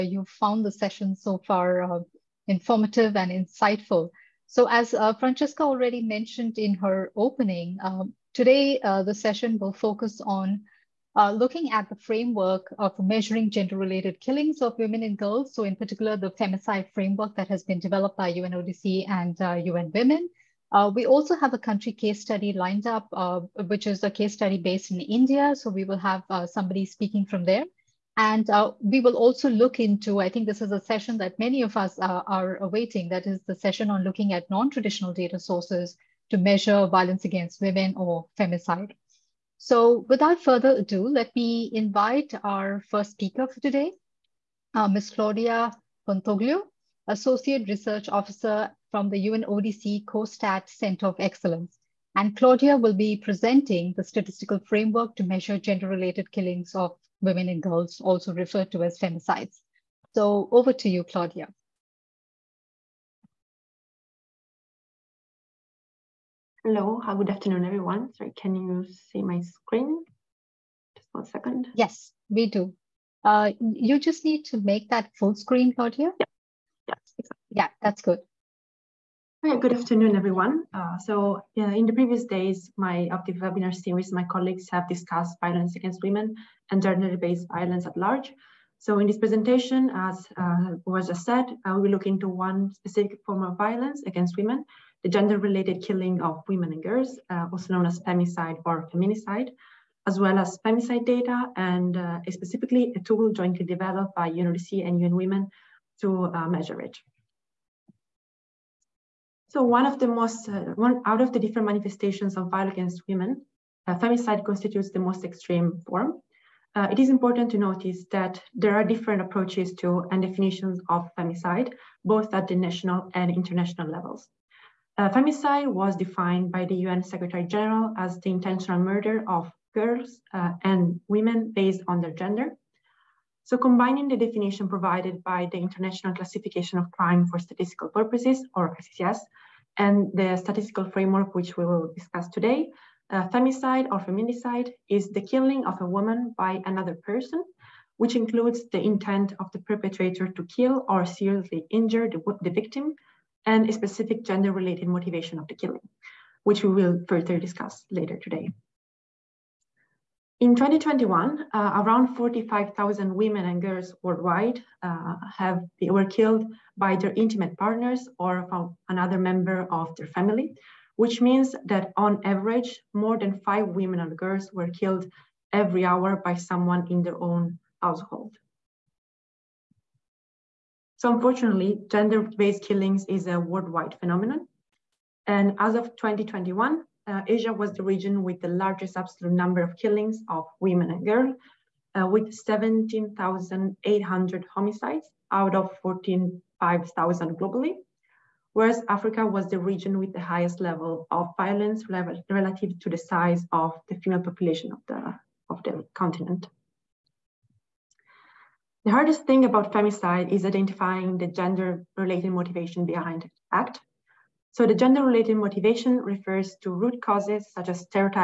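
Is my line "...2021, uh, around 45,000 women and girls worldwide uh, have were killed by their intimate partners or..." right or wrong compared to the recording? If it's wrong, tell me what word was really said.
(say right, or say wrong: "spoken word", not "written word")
right.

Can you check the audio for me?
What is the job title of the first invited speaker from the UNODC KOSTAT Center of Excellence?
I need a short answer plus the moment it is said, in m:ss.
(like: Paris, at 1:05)
Associate Research Officer, at 0:47.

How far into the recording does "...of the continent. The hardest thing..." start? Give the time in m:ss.
3:25.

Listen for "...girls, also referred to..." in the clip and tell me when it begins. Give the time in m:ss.
0:57.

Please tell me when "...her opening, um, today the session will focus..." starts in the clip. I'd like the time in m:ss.
0:06.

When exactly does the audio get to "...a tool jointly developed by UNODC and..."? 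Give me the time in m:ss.
1:42.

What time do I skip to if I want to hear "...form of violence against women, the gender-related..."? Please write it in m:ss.
1:33.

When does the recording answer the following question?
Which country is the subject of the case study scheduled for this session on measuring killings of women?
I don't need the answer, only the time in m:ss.
0:25.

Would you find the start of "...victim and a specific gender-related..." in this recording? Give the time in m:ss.
2:32.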